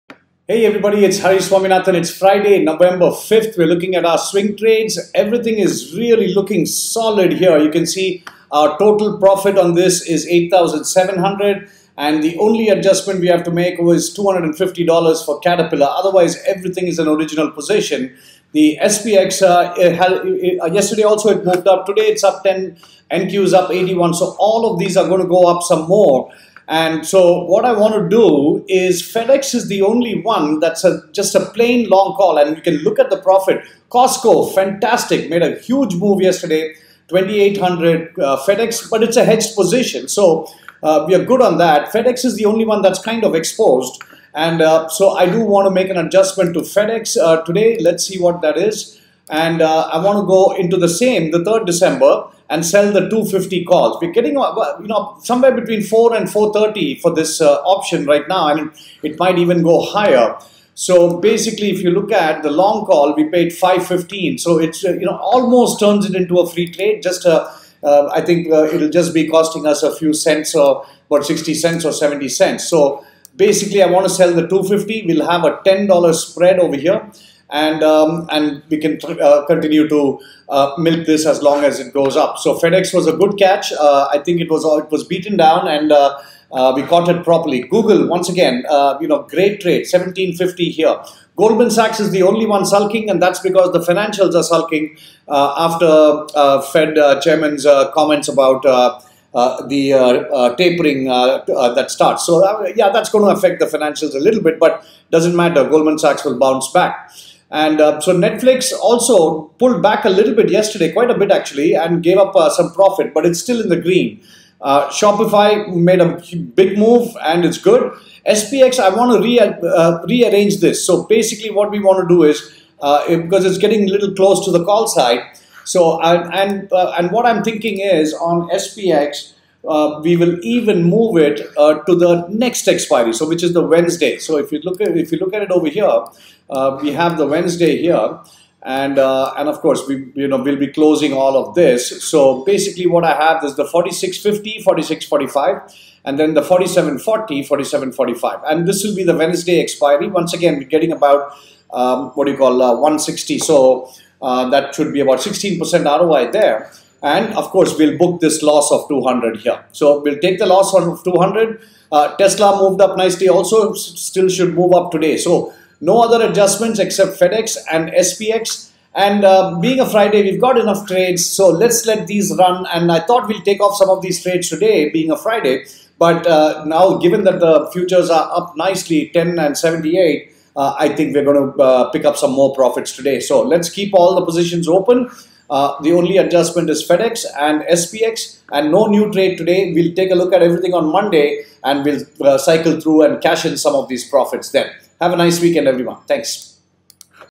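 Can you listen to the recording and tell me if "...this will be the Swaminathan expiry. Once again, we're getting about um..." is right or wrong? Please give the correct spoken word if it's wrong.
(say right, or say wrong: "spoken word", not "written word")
wrong: "Wednesday", not "Swaminathan".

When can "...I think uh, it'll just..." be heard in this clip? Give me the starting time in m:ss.
1:08.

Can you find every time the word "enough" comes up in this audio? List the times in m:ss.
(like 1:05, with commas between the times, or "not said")
2:50.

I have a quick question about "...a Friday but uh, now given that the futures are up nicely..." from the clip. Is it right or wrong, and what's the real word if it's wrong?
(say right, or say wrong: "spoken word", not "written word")
right.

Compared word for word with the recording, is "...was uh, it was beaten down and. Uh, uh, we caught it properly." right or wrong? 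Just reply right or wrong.
right.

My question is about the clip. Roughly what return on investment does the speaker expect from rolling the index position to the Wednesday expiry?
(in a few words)
16%.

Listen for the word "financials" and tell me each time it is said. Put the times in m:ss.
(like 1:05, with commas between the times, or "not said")
1:33, 1:43.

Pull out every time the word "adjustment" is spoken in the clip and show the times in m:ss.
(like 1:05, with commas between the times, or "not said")
0:12, 0:45, 2:46, 3:06.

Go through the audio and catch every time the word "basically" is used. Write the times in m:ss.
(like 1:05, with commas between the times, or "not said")
1:01, 1:13, 2:01, 2:22.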